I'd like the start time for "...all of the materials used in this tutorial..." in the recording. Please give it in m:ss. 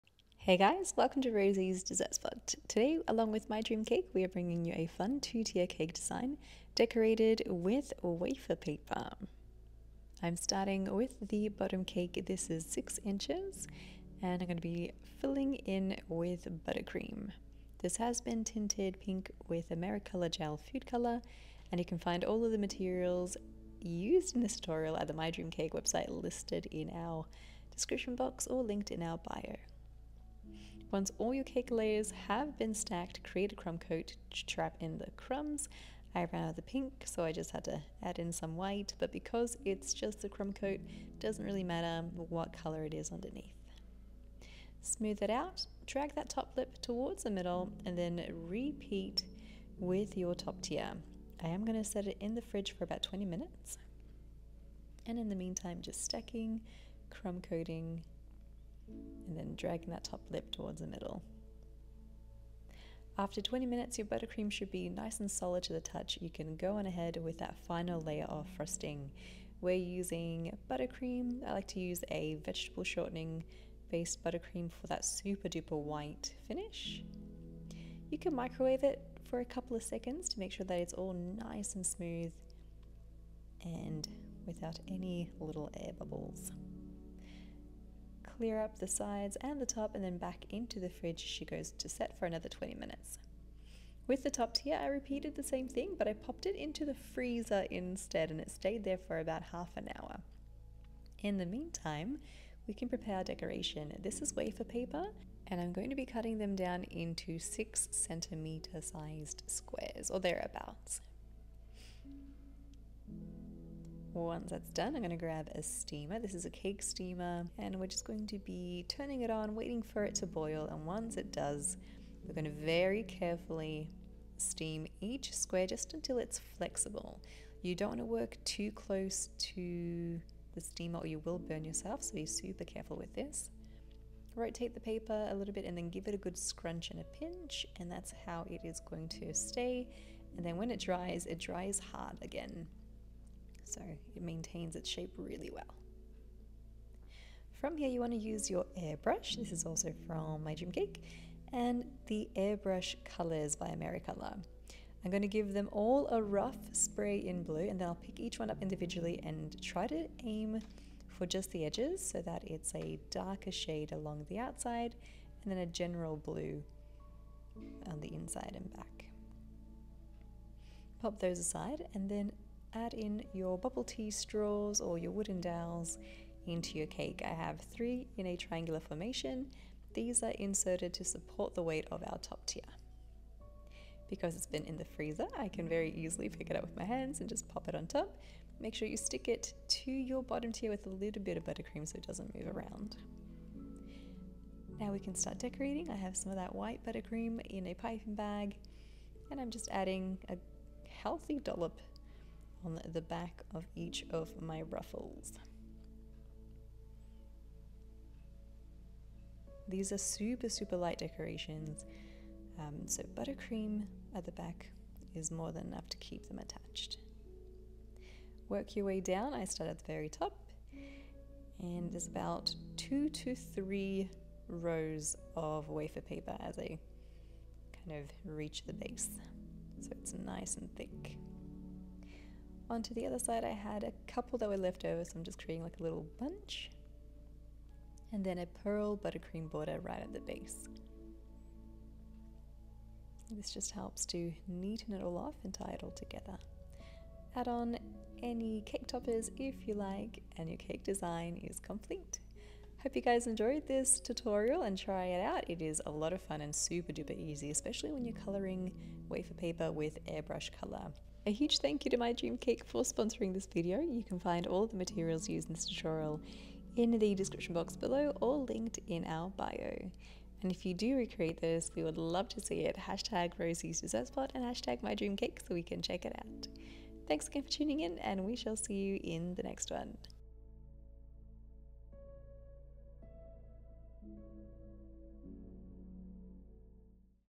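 0:22.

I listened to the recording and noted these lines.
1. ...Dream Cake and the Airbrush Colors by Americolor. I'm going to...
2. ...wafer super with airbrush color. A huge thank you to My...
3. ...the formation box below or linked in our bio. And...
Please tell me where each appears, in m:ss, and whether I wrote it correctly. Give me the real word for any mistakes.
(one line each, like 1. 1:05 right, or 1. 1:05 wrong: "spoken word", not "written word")
1. 2:30 right
2. 4:19 wrong: "paper", not "super"
3. 4:26 wrong: "description", not "formation".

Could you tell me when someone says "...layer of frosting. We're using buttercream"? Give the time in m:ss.
1:08.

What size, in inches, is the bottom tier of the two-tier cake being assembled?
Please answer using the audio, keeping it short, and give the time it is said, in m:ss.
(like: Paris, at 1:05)
6, at 0:12.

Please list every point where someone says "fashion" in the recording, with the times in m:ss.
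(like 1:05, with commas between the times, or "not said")
not said.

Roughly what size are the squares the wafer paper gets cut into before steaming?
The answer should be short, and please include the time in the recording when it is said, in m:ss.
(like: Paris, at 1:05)
6 centimeters, at 1:47.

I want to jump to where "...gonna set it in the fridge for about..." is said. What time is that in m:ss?
0:51.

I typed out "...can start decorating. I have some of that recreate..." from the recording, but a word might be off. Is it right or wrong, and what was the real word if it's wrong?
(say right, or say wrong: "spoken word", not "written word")
wrong: "white", not "recreate".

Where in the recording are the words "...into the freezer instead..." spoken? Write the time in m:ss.
1:36.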